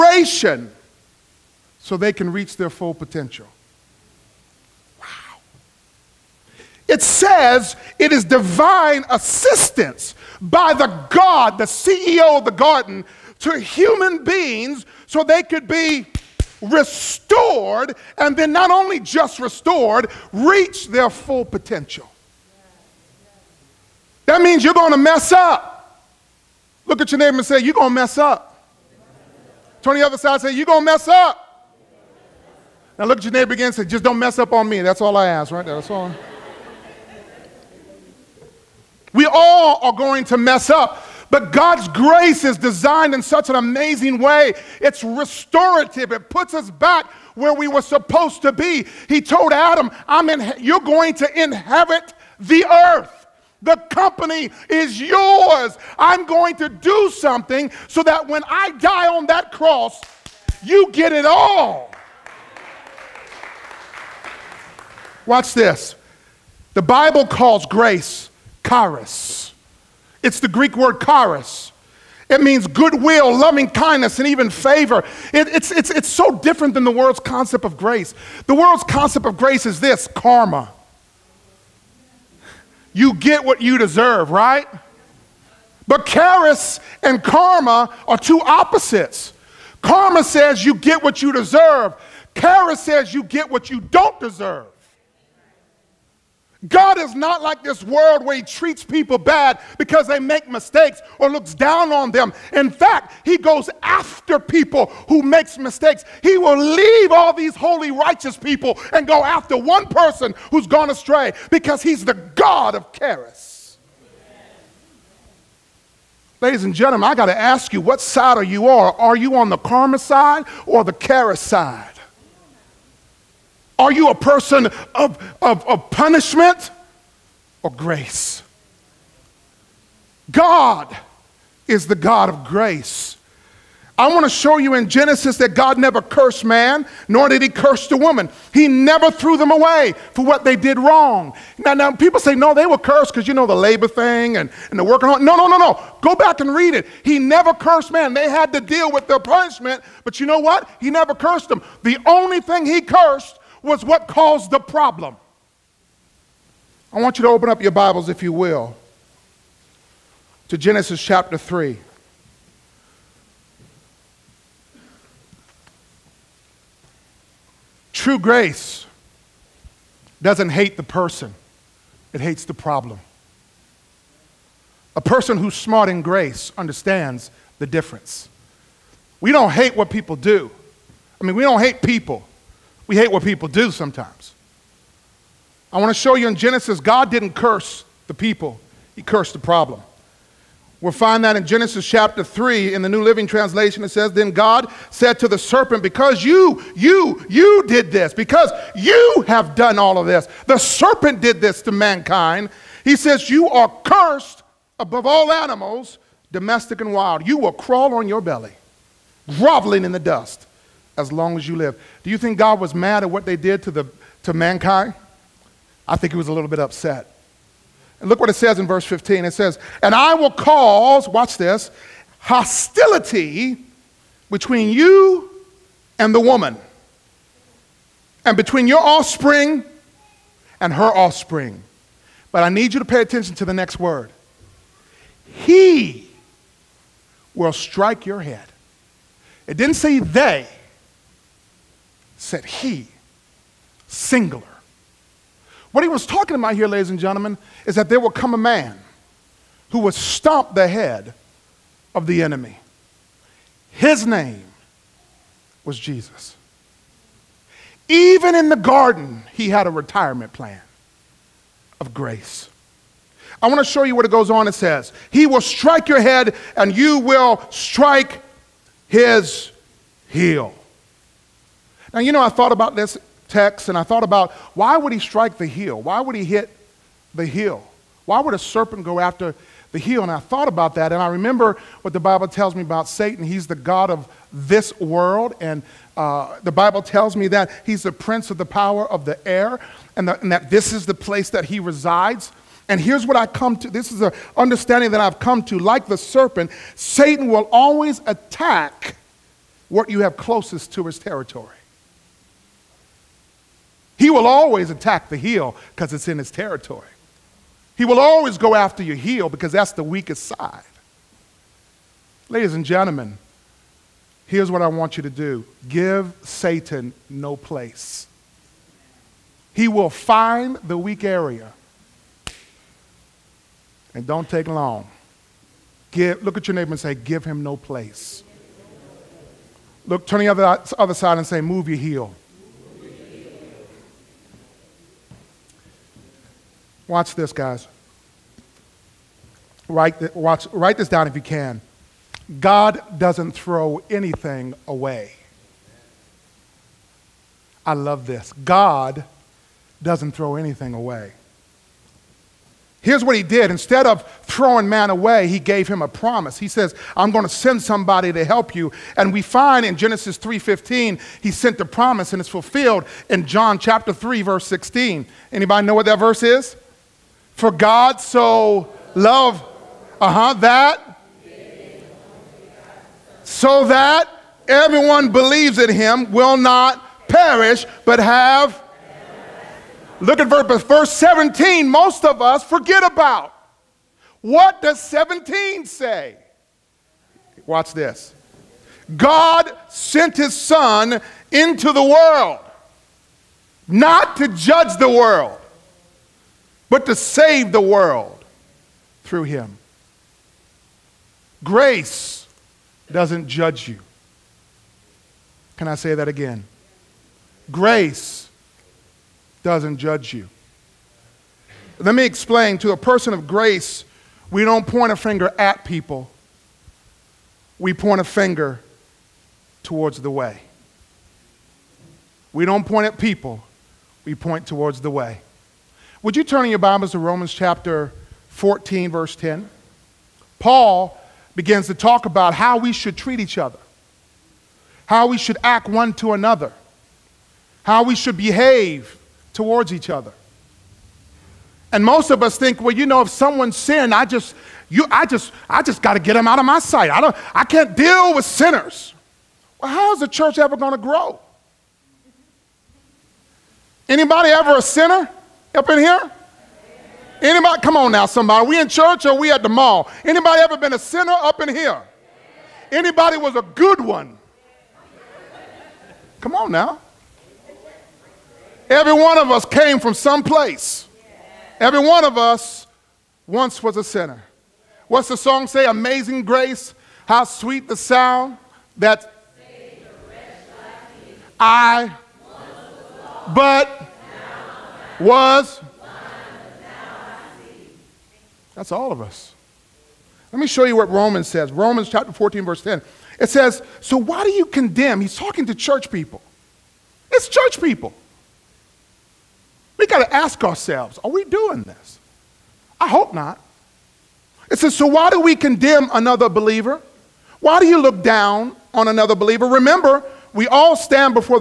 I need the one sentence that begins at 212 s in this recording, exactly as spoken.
Do you think God was mad at what they did to, the, to mankind?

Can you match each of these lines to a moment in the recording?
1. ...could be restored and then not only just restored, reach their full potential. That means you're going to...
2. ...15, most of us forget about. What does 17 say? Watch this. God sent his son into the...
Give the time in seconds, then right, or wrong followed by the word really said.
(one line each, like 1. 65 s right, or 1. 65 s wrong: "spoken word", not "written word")
1. 15 s right
2. 380 s wrong: "17", not "15".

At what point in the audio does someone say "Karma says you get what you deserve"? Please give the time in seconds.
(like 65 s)
89 s.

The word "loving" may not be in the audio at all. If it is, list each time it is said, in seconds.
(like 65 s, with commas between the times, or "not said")
73 s.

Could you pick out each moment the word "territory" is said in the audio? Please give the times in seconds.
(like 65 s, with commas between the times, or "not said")
300 s, 306 s.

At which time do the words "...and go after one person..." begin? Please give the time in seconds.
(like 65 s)
108 s.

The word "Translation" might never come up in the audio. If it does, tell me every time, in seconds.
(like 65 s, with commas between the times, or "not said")
193 s.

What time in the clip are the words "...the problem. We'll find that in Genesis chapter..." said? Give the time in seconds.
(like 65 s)
189 s.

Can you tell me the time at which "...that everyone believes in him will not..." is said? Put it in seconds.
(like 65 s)
373 s.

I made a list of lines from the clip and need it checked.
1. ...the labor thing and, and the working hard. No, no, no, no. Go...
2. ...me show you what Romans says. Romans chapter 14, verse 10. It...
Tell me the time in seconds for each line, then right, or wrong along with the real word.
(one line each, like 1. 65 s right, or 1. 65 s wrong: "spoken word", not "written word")
1. 143 s right
2. 490 s right.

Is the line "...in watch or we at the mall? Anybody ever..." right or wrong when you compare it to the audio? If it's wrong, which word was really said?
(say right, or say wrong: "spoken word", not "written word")
wrong: "church", not "watch".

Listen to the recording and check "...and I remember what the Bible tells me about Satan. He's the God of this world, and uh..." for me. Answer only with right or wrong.
right.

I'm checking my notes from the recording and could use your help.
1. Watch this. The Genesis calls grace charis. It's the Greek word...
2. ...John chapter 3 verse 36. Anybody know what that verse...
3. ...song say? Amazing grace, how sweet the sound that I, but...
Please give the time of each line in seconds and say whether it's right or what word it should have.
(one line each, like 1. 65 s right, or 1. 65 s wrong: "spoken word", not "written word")
1. 65 s wrong: "Bible", not "Genesis"
2. 363 s wrong: "16", not "36"
3. 475 s right.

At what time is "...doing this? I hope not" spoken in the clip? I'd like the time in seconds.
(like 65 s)
501 s.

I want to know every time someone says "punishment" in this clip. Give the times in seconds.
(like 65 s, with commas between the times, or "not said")
125 s, 149 s.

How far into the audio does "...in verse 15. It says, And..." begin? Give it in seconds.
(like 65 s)
218 s.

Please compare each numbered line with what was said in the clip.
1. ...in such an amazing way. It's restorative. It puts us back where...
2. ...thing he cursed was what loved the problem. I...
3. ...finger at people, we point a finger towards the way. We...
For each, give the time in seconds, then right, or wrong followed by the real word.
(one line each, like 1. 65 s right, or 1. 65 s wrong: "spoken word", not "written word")
1. 43 s right
2. 152 s wrong: "caused", not "loved"
3. 414 s right.